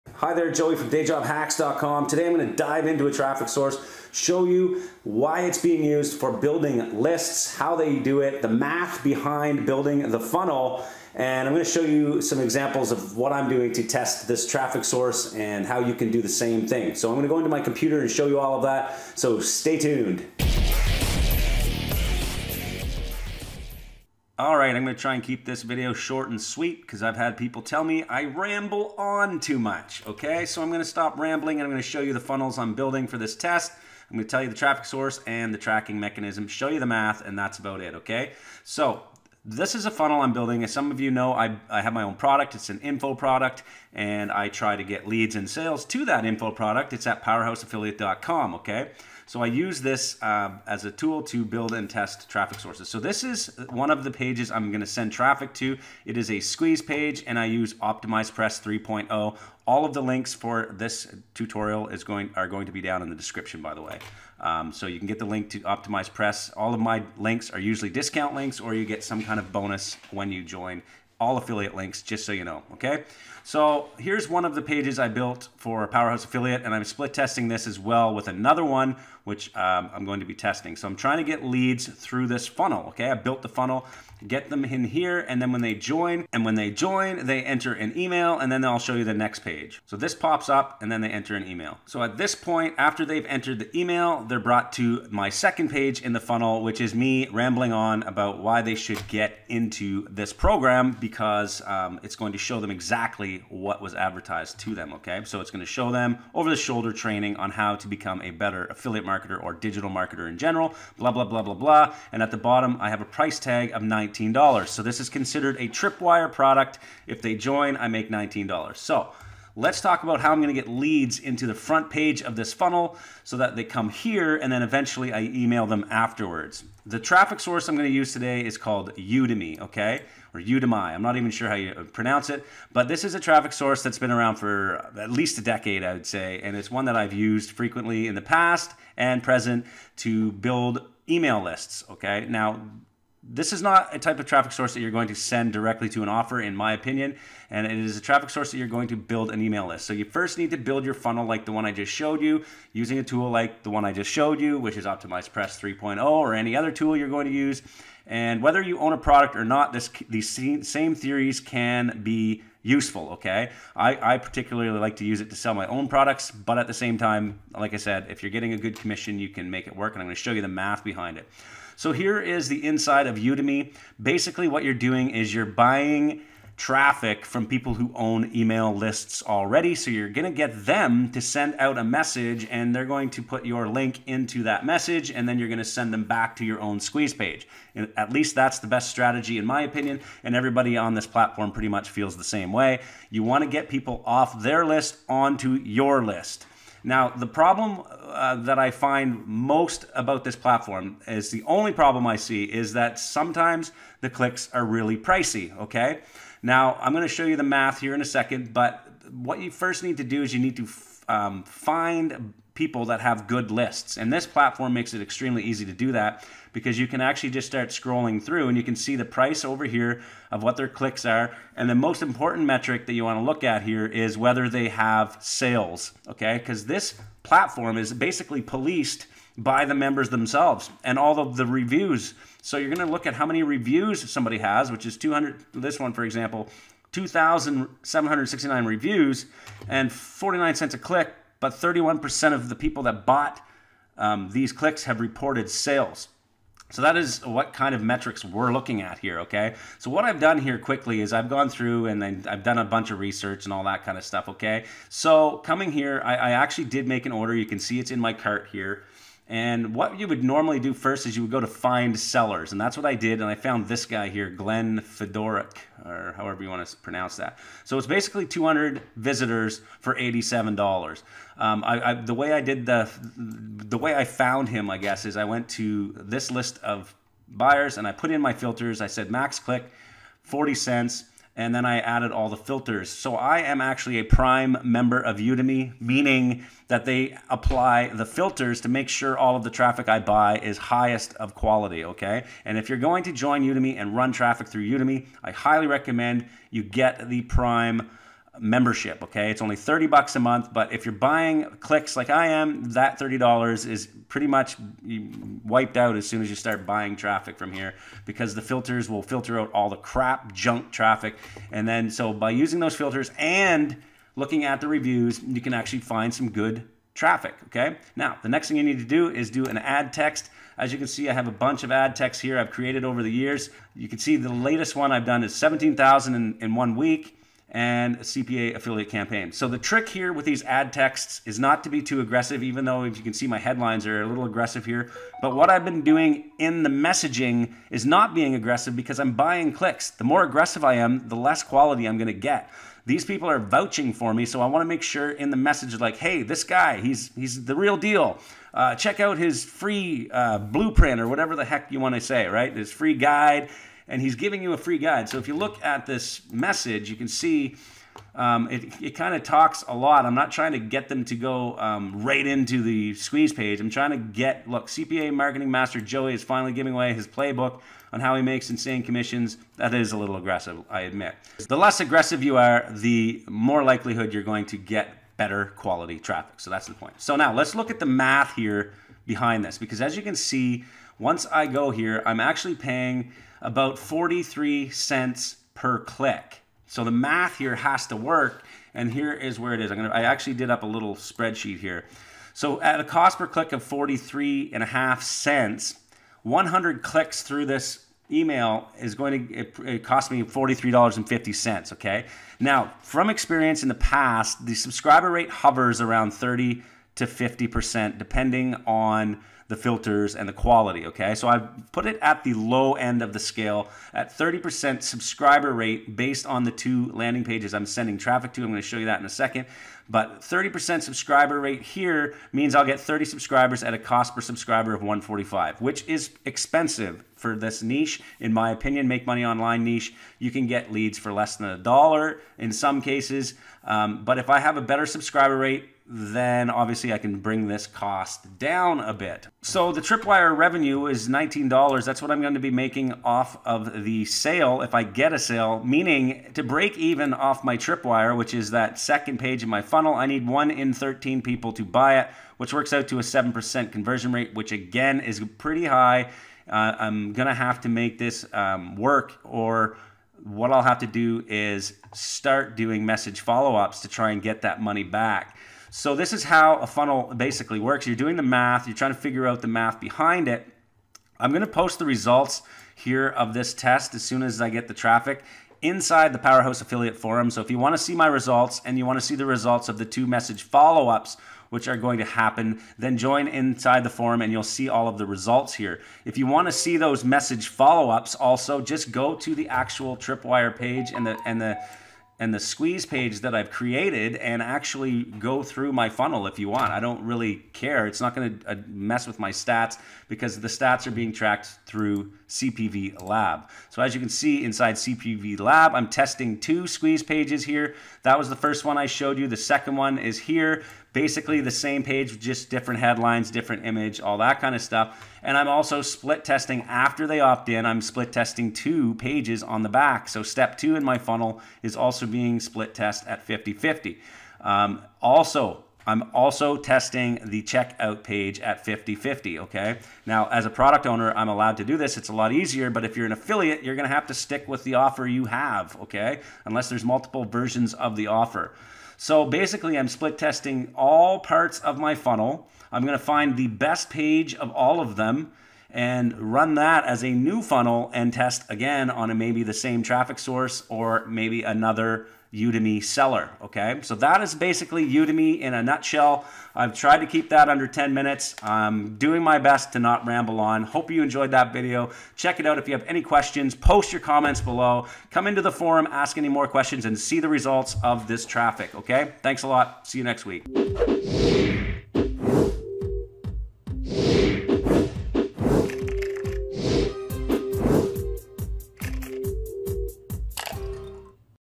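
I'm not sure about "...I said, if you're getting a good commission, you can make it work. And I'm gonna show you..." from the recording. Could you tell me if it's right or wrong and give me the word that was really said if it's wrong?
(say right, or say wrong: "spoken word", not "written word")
right.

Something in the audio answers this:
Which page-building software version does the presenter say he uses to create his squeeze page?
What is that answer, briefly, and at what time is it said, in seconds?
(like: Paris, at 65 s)
Optimize Press 3.0, at 57 s.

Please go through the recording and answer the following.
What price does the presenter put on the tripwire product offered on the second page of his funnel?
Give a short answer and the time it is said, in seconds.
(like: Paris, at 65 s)
$19, at 113 s.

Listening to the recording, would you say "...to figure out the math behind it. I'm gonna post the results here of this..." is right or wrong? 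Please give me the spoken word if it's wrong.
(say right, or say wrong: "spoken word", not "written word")
right.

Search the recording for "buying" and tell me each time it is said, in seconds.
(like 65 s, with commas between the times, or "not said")
175 s, 300 s, 306 s, 339 s.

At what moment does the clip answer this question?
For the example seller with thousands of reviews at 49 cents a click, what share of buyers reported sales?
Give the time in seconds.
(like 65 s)
241 s.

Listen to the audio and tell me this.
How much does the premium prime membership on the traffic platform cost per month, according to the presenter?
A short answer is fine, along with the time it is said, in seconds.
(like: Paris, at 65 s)
$30, at 299 s.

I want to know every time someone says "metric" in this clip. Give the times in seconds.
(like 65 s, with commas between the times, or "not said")
222 s, 247 s.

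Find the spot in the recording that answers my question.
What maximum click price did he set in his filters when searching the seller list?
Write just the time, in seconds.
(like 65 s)
280 s.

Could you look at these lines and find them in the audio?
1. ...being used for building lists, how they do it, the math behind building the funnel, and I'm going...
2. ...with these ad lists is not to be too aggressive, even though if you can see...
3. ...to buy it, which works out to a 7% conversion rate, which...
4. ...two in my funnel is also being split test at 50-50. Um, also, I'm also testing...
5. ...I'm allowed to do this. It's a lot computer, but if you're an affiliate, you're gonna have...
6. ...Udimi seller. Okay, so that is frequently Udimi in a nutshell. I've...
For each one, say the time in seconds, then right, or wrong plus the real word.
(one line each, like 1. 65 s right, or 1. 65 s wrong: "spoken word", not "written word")
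1. 5 s right
2. 330 s wrong: "texts", not "lists"
3. 451 s right
4. 520 s right
5. 531 s wrong: "easier", not "computer"
6. 552 s wrong: "basically", not "frequently".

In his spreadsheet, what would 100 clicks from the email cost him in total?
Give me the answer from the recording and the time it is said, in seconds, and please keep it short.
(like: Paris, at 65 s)
$43.50, at 400 s.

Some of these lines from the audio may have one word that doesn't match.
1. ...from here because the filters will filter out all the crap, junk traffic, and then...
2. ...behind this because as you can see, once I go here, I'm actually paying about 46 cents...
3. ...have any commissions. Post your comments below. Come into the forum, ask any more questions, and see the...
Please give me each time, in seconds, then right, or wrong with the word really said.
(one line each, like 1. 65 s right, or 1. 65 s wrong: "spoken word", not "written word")
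1. 307 s right
2. 379 s wrong: "43", not "46"
3. 562 s wrong: "questions", not "commissions".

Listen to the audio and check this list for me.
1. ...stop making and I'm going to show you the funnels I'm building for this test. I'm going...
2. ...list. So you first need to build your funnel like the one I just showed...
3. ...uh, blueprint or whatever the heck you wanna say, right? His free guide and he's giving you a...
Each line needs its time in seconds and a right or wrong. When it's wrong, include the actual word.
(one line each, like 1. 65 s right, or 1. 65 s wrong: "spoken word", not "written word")
1. 30 s wrong: "rambling", not "making"
2. 149 s right
3. 350 s right.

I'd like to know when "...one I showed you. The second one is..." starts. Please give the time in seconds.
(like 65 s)
508 s.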